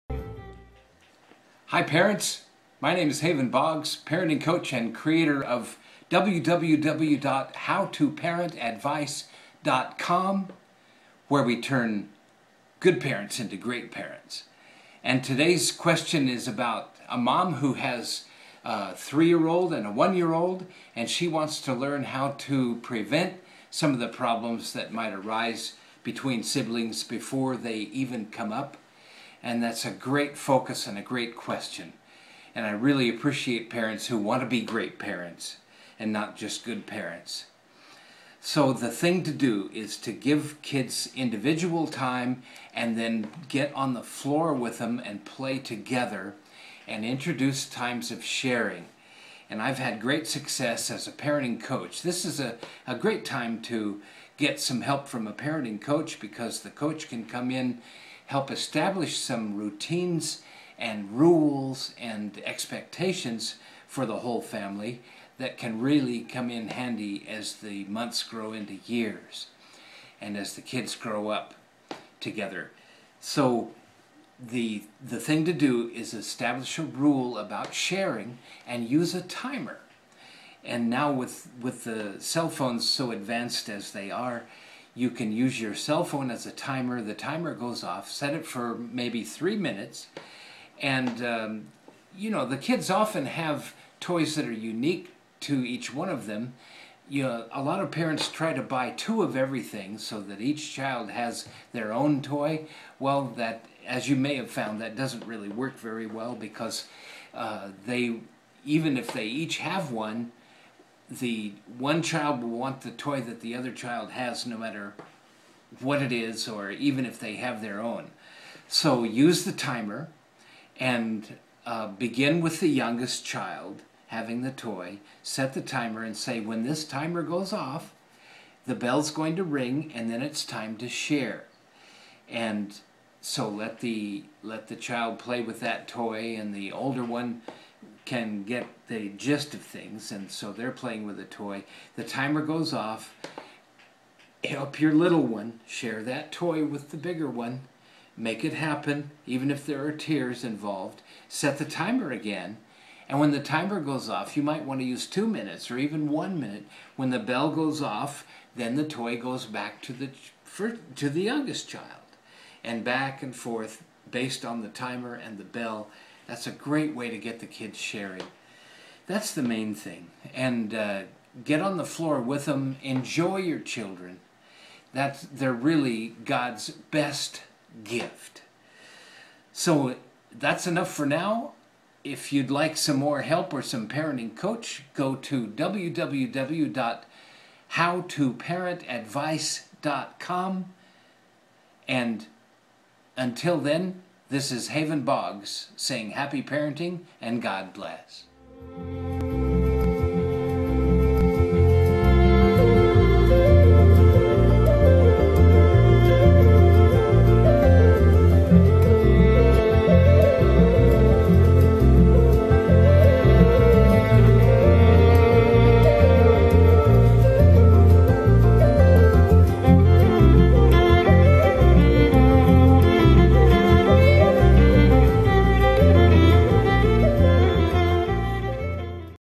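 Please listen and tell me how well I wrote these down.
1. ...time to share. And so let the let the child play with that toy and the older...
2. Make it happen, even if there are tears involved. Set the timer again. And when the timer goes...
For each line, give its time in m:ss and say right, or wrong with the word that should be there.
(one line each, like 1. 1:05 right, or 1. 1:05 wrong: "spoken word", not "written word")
1. 2:10 right
2. 2:28 right.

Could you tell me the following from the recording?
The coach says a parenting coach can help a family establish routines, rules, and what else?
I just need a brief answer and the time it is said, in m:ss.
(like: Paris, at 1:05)
Expectations, at 1:02.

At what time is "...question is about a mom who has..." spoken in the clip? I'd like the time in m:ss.
0:15.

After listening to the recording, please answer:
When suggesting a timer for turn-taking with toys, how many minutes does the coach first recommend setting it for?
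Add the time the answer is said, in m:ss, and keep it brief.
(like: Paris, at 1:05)
3, at 1:29.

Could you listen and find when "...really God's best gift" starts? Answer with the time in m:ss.
2:55.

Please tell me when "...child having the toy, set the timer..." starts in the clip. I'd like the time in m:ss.
2:03.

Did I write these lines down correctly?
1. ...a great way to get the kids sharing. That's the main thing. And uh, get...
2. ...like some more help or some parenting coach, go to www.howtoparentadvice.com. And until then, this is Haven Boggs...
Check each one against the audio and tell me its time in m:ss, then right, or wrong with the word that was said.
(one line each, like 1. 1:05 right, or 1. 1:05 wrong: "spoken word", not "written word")
1. 2:46 right
2. 3:02 right.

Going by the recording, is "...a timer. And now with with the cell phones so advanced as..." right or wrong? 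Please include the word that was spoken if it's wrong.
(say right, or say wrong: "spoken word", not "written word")
right.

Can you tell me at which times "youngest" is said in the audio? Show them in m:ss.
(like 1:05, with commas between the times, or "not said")
2:02, 2:41.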